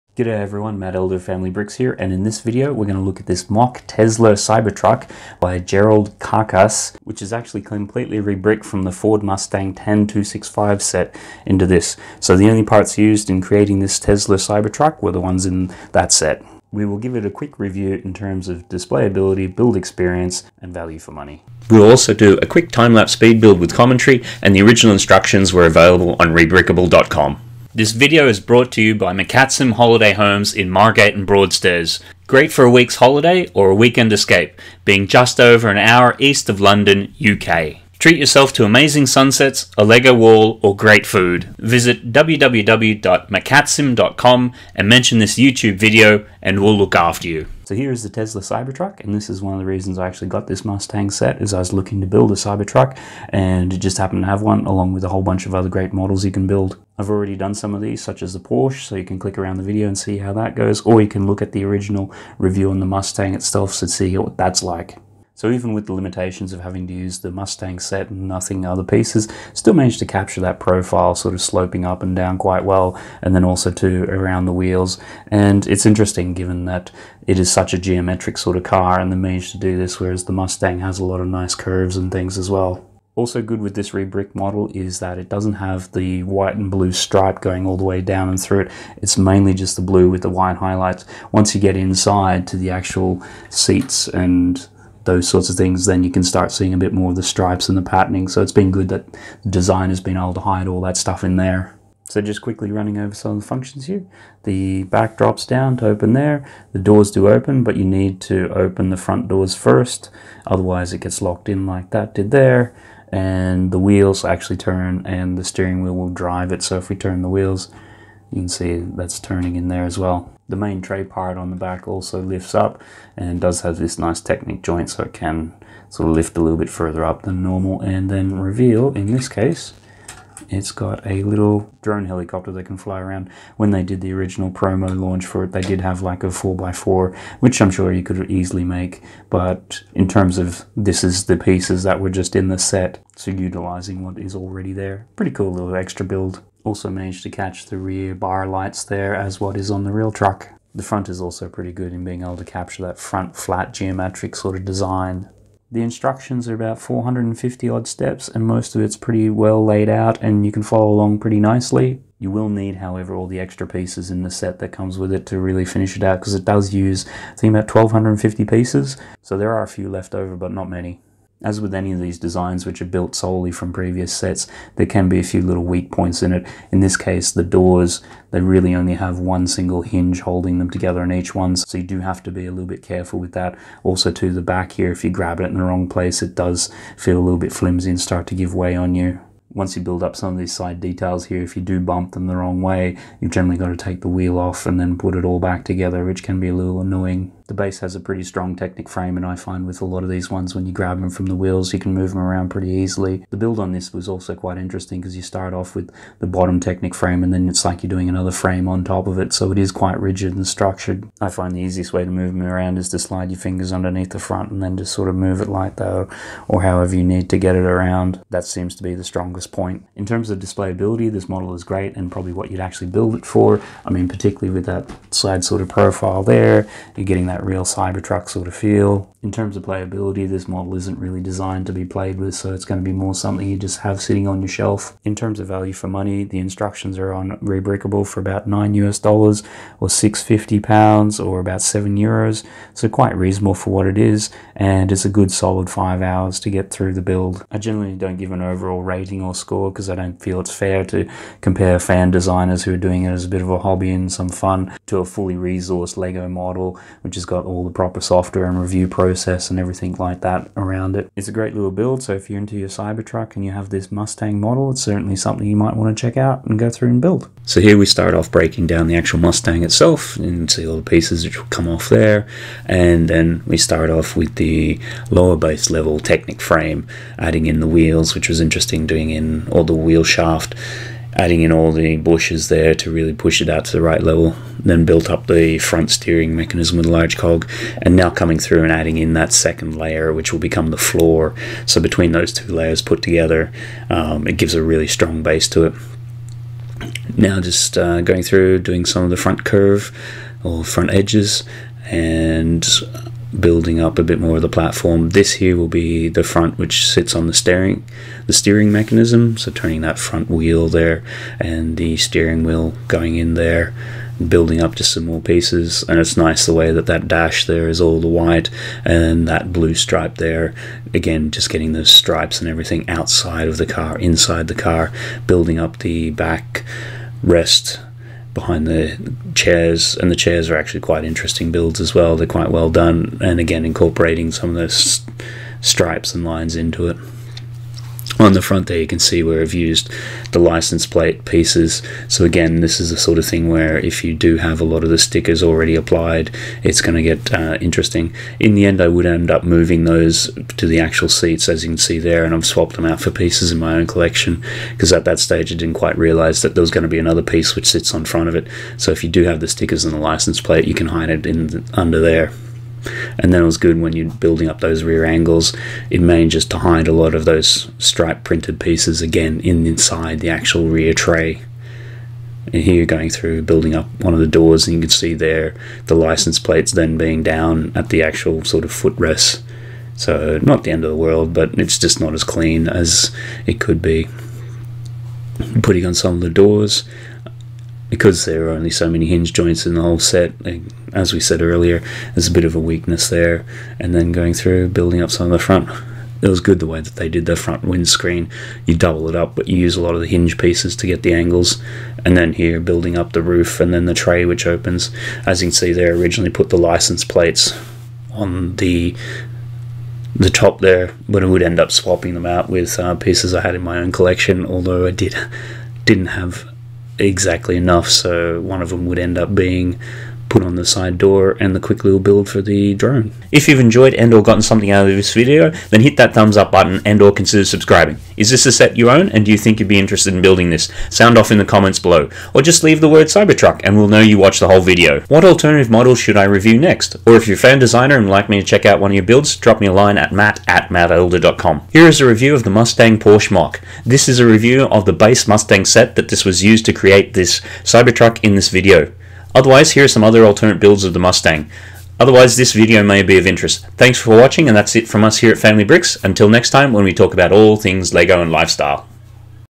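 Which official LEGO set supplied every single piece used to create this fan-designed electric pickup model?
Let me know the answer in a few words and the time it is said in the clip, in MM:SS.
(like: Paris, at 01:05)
Ford Mustang 10265, at 00:08.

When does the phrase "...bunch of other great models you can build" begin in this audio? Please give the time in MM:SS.
00:55.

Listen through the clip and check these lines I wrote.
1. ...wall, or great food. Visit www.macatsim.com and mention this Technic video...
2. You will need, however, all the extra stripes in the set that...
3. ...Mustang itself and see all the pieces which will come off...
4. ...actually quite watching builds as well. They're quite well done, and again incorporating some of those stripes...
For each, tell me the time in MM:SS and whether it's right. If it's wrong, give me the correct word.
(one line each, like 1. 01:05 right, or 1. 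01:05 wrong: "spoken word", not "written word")
1. 00:40 wrong: "YouTube", not "Technic"
2. 02:42 wrong: "pieces", not "stripes"
3. 04:29 right
4. 05:30 wrong: "interesting", not "watching".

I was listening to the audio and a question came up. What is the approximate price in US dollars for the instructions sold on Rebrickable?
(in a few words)
9 US dollars.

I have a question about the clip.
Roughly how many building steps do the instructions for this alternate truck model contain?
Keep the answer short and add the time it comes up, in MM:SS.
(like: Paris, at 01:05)
450, at 02:36.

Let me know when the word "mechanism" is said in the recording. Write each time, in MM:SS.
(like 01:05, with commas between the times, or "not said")
04:46, 05:08.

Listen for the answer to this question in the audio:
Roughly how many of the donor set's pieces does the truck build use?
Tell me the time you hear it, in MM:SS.
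02:47.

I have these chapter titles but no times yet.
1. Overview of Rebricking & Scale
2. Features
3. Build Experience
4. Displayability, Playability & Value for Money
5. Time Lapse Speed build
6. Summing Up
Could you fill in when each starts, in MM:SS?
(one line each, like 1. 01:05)
1. 00:50
2. 01:40
3. 03:20
4. 03:40
5. 04:25
6. 07:00.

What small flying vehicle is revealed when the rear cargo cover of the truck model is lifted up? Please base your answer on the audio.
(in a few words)
drone helicopter.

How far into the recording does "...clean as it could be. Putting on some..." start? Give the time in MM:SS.
06:22.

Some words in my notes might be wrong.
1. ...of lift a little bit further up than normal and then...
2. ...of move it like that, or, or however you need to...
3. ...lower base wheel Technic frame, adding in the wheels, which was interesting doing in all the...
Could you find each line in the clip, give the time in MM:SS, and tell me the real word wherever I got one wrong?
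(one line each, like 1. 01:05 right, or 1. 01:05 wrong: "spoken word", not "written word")
1. 02:06 right
2. 03:35 right
3. 04:35 wrong: "level", not "wheel".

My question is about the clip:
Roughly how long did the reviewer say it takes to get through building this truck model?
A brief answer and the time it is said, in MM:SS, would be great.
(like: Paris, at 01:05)
5 hours, at 04:05.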